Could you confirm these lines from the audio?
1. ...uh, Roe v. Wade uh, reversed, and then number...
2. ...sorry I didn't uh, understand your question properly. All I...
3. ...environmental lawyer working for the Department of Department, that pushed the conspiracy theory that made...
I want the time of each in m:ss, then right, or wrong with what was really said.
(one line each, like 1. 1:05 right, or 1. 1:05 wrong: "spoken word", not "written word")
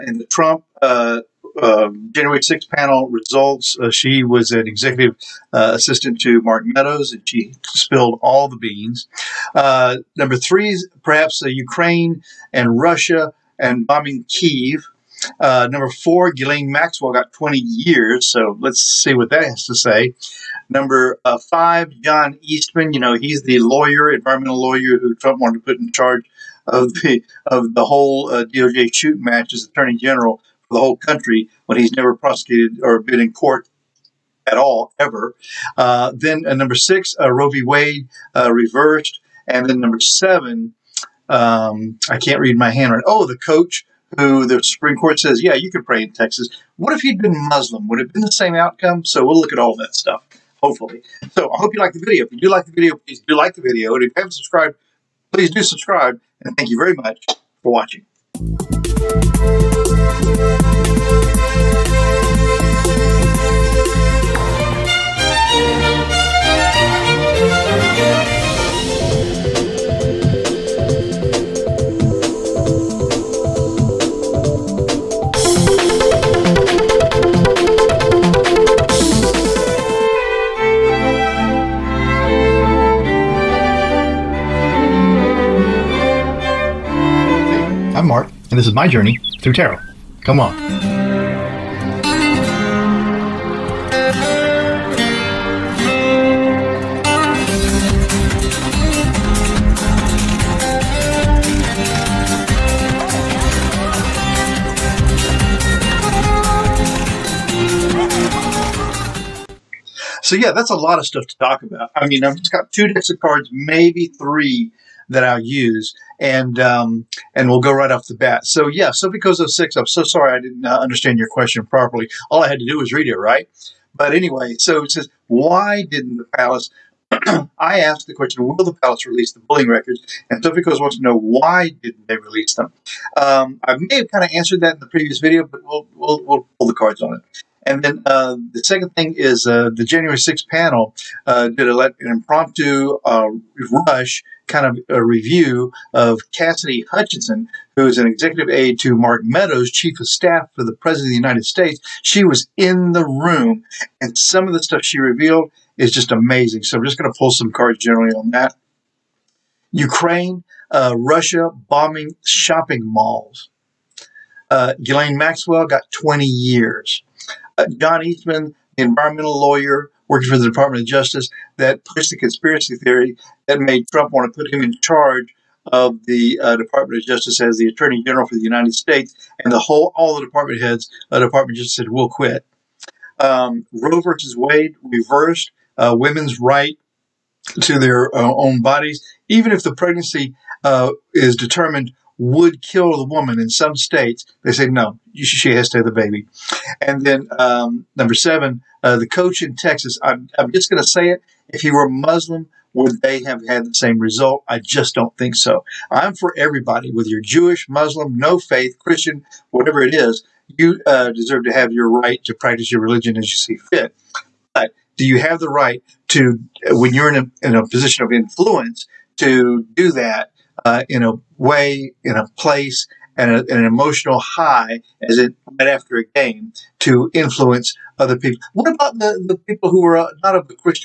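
1. 0:37 right
2. 2:00 right
3. 2:48 wrong: "Justice", not "Department".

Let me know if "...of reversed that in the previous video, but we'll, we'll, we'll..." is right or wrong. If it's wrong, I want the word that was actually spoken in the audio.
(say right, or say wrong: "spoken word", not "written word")
wrong: "answered", not "reversed".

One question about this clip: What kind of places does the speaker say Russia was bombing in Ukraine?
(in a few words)
shopping malls.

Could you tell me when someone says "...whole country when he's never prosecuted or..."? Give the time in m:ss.
0:30.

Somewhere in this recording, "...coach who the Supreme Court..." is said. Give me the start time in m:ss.
0:43.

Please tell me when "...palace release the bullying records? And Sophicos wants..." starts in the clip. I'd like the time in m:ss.
2:08.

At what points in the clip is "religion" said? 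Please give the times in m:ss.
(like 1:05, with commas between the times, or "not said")
3:32.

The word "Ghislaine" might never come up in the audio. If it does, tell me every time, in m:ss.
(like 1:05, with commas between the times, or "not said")
0:16, 2:44.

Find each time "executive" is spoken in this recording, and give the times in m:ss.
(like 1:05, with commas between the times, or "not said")
0:04, 2:28.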